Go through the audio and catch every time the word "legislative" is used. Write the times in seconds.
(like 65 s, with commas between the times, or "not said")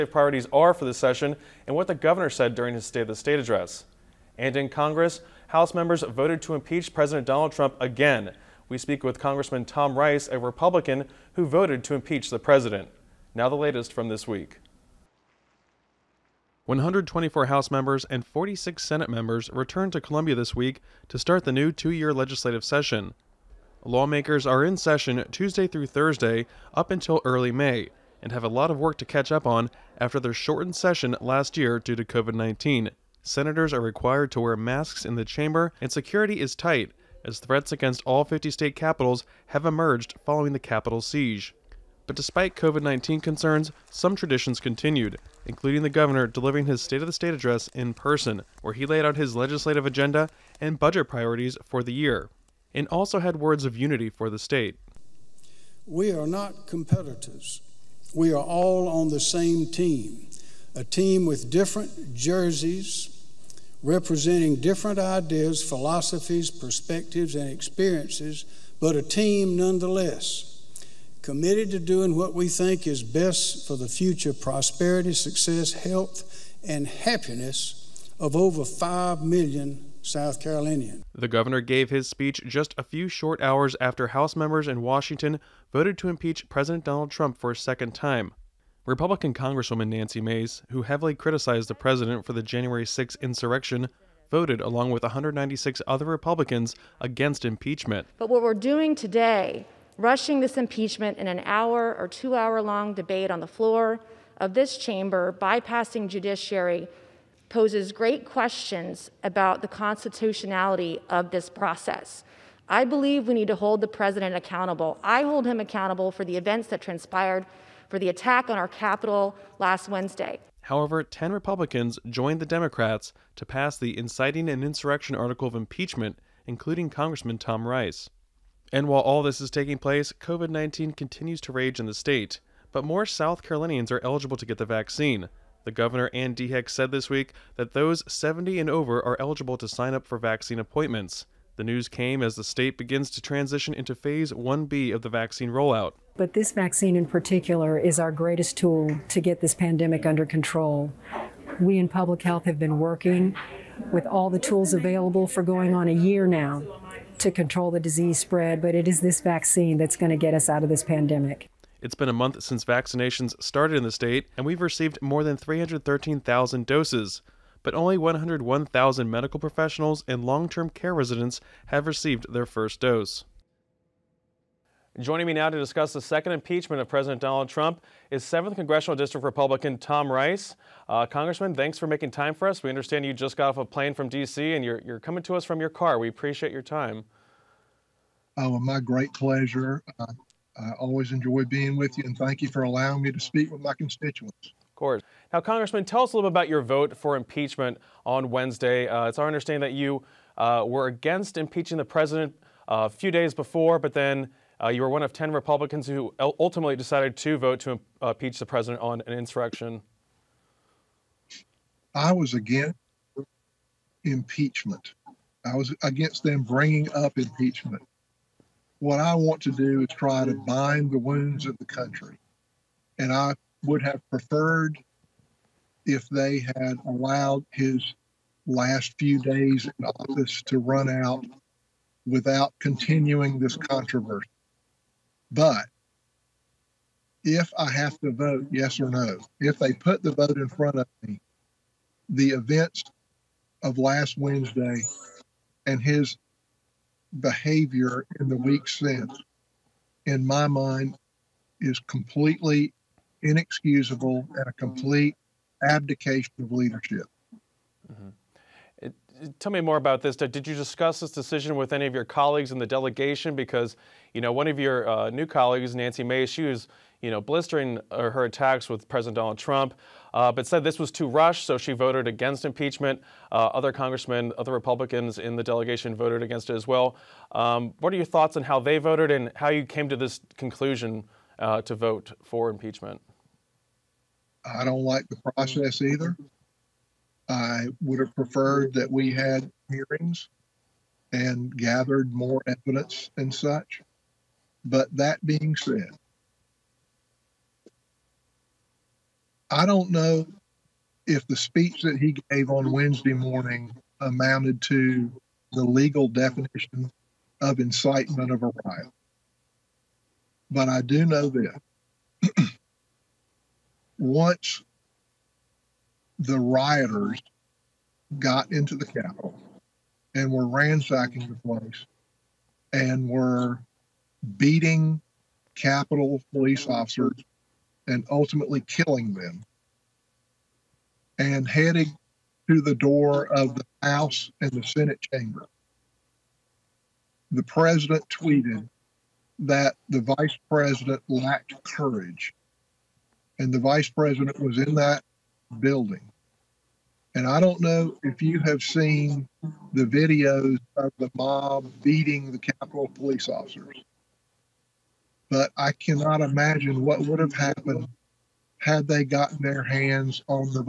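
22 s, 49 s.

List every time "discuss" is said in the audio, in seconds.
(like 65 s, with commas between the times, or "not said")
175 s, 260 s.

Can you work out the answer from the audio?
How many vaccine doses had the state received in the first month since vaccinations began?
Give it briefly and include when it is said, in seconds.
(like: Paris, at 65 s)
313,000, at 165 s.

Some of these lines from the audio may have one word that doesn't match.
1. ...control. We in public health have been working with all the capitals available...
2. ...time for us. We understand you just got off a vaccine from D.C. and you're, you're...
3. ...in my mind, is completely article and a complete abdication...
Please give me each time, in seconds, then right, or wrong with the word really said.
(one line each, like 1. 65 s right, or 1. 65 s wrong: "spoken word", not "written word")
1. 150 s wrong: "tools", not "capitals"
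2. 182 s wrong: "plane", not "vaccine"
3. 250 s wrong: "inexcusable", not "article".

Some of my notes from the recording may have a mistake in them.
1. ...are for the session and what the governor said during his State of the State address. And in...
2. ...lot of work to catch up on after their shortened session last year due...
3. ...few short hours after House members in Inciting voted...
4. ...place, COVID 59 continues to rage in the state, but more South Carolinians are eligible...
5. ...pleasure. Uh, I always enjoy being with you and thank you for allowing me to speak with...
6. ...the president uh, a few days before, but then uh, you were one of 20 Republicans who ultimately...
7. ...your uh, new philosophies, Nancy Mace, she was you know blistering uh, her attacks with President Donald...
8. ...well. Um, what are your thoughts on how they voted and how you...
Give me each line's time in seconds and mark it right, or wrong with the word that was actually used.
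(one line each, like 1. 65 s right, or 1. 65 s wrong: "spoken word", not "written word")
1. 0 s right
2. 28 s right
3. 82 s wrong: "Washington", not "Inciting"
4. 129 s wrong: "19", not "59"
5. 189 s right
6. 201 s wrong: "10", not "20"
7. 264 s wrong: "colleagues", not "philosophies"
8. 276 s right.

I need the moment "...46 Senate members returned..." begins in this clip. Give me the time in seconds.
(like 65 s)
18 s.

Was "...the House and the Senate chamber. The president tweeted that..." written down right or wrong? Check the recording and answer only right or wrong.
right.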